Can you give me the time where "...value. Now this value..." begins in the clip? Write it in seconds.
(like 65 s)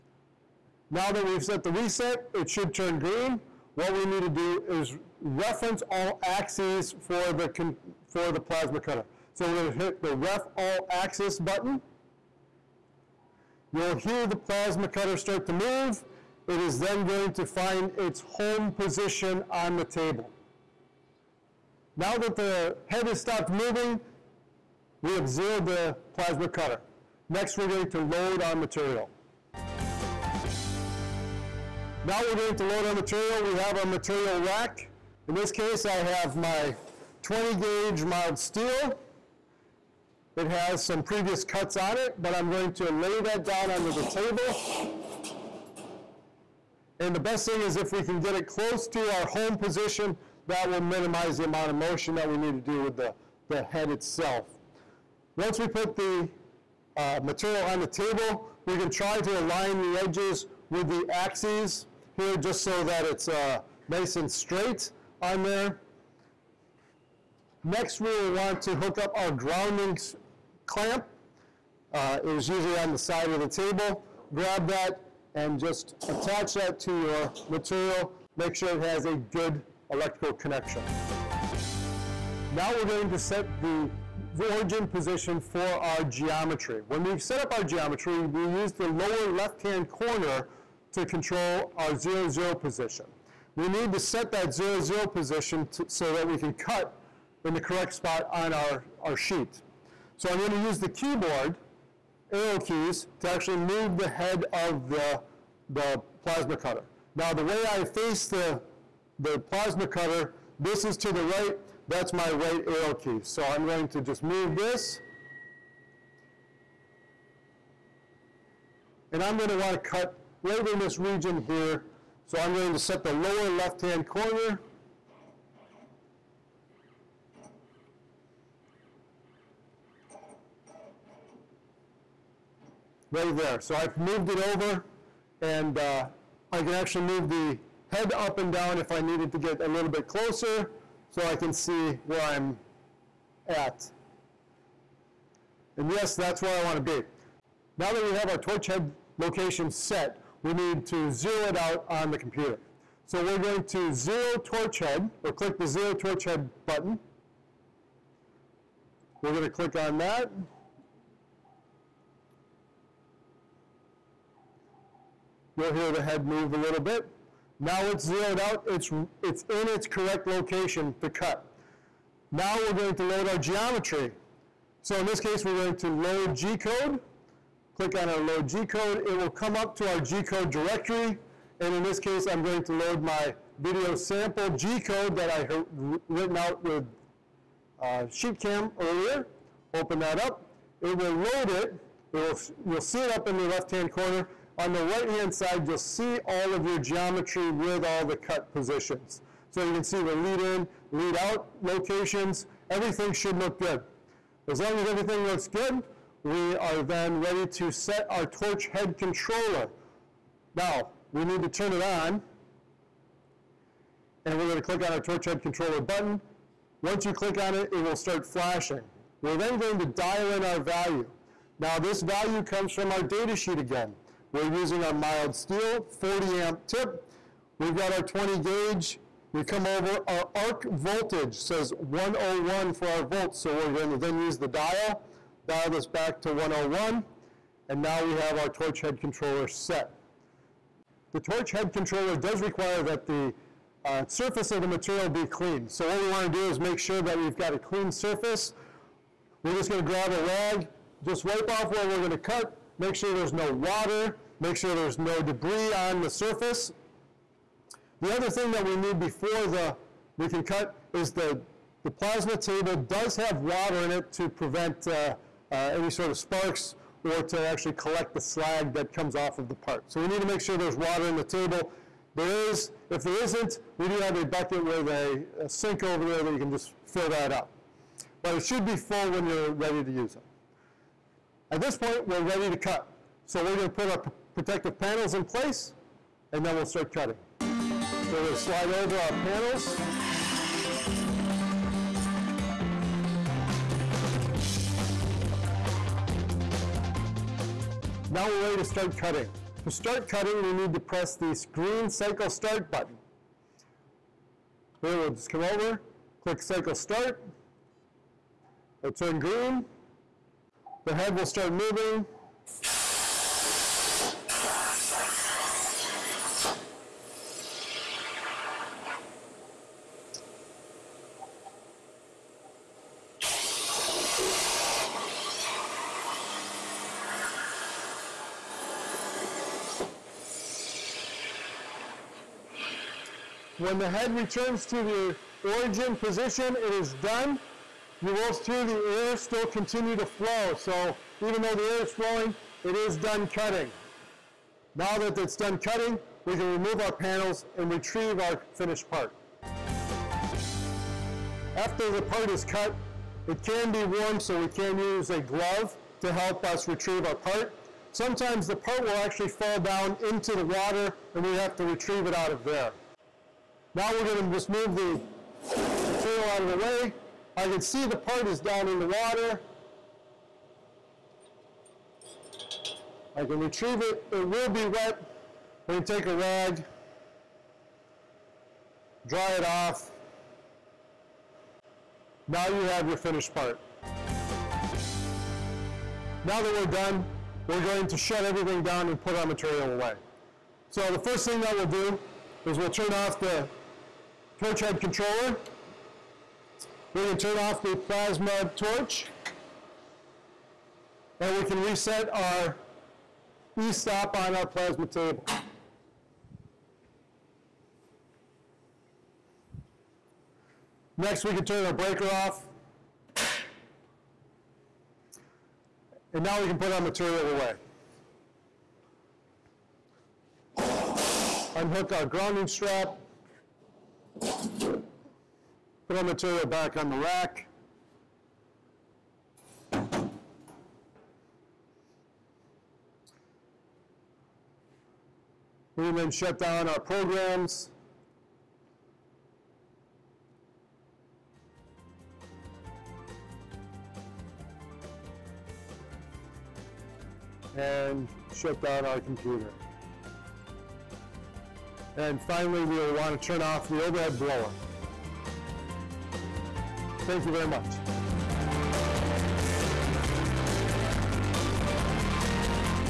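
220 s.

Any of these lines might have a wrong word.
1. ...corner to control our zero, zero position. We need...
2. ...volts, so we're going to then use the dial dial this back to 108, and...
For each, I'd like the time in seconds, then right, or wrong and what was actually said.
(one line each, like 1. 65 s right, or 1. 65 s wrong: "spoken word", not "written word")
1. 89 s right
2. 233 s wrong: "101", not "108".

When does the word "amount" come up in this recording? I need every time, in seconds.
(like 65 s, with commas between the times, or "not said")
51 s.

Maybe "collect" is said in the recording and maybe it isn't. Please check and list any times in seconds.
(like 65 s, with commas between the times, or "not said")
267 s.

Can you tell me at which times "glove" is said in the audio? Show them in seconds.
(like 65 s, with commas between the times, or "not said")
355 s.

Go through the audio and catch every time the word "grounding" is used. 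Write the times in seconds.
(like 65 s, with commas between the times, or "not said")
69 s, 422 s.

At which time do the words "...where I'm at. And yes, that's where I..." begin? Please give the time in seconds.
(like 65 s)
142 s.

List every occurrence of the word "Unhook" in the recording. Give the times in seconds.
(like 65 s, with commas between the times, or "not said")
421 s.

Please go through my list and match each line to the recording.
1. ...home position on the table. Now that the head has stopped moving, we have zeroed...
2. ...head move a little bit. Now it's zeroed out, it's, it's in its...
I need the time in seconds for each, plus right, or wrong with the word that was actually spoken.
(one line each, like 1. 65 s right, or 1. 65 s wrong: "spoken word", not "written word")
1. 18 s right
2. 166 s right.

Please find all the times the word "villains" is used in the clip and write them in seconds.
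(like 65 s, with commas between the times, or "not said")
not said.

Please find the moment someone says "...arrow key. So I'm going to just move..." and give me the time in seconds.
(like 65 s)
112 s.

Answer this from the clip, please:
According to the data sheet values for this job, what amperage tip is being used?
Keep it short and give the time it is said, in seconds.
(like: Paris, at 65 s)
40 amp, at 225 s.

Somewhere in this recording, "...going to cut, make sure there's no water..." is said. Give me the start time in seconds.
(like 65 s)
251 s.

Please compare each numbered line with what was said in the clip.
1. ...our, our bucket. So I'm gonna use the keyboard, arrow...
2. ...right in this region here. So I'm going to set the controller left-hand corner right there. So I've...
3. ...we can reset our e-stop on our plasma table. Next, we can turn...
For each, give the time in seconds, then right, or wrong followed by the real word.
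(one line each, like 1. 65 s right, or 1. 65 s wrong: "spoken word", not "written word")
1. 98 s wrong: "sheet", not "bucket"
2. 120 s wrong: "lower", not "controller"
3. 401 s right.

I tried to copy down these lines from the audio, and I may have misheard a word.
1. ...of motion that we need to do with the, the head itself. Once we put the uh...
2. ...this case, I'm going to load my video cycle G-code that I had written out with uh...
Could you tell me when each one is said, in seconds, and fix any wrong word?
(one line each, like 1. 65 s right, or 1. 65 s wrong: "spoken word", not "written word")
1. 51 s right
2. 181 s wrong: "sample", not "cycle".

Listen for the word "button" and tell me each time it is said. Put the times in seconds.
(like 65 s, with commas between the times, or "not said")
11 s, 156 s, 215 s, 302 s.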